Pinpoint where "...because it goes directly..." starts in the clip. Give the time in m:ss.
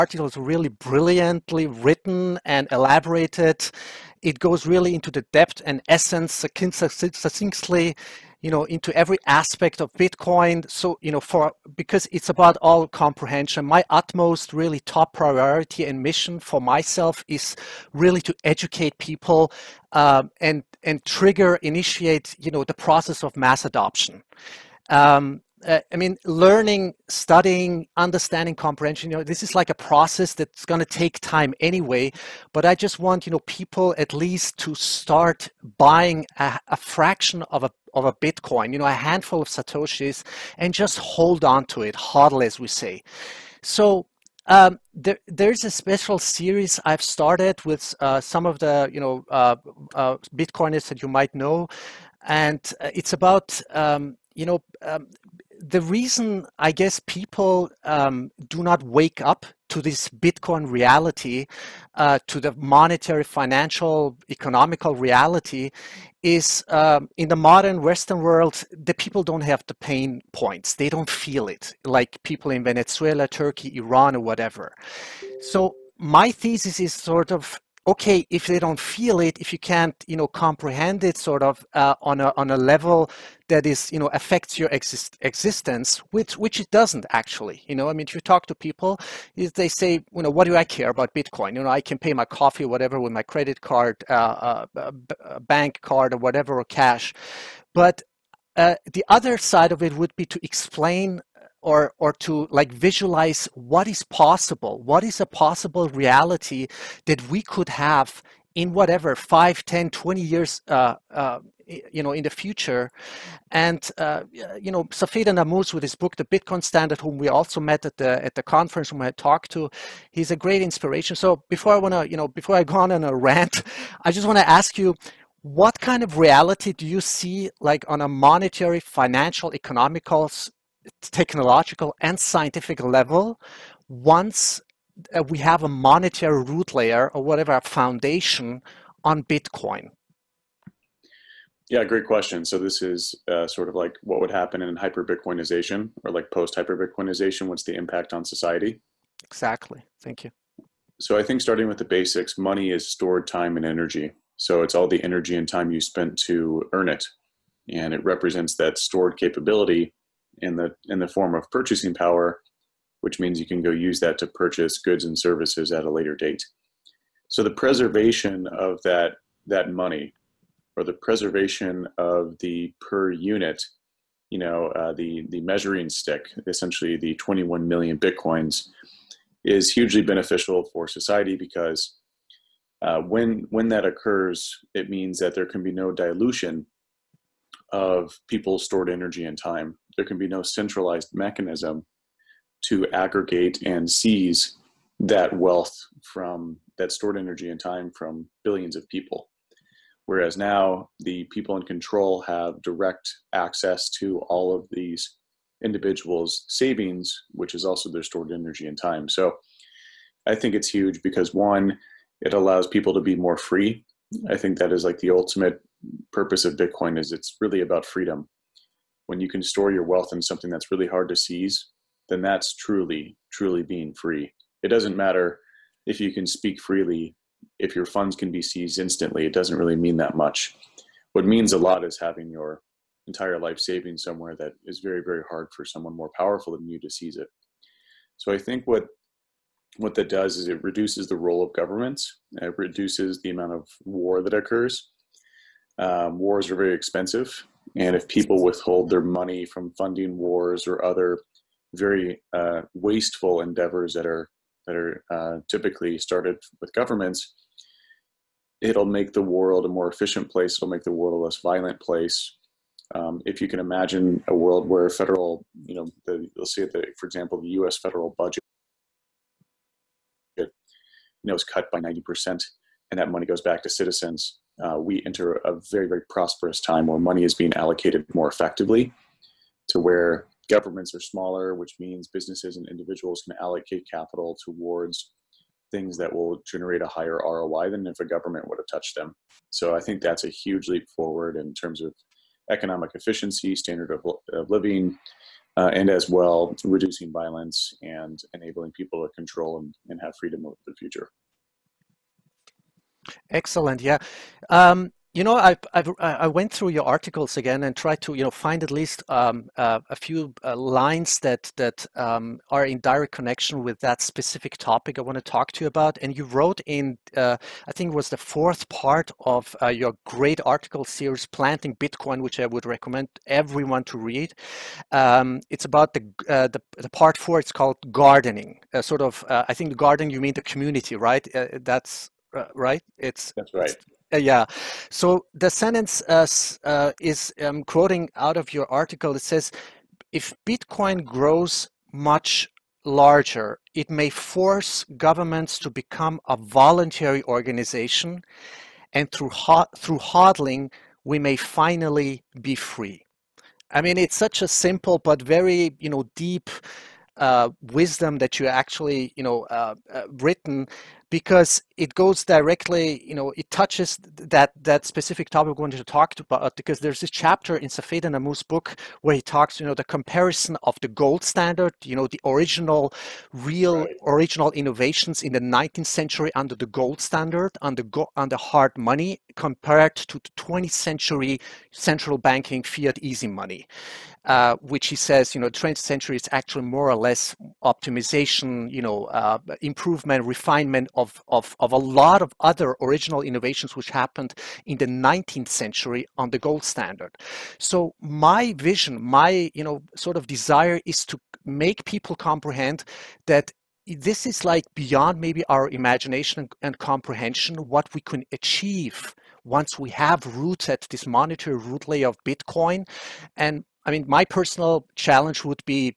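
6:01.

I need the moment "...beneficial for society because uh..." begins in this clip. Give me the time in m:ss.
3:00.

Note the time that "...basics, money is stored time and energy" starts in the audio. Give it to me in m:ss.
2:31.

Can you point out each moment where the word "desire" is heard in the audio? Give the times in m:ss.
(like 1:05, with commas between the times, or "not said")
6:40.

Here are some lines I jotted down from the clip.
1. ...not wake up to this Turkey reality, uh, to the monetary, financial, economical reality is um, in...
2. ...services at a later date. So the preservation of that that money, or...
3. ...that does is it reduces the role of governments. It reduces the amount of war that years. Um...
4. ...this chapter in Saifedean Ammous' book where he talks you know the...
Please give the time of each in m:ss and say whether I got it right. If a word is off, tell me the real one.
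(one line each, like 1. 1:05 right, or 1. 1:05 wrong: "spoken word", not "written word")
1. 0:58 wrong: "Bitcoin", not "Turkey"
2. 2:45 right
3. 3:59 wrong: "occurs", not "years"
4. 6:06 right.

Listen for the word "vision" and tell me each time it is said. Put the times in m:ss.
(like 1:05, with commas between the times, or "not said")
6:38.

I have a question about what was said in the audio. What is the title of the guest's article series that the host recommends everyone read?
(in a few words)
Planting Bitcoin.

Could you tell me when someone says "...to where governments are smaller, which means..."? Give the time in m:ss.
4:39.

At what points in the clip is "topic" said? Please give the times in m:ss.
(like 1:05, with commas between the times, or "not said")
5:14, 6:05.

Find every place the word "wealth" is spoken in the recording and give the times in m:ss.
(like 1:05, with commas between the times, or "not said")
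3:15, 3:39.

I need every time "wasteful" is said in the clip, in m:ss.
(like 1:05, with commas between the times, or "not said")
4:12.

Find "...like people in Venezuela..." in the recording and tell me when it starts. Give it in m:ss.
1:11.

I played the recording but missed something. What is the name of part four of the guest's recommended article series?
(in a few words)
Gardening.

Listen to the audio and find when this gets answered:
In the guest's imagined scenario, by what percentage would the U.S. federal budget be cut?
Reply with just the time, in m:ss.
4:31.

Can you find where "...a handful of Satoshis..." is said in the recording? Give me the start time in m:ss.
0:38.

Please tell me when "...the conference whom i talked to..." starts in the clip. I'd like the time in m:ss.
1:58.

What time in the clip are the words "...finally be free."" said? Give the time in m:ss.
5:51.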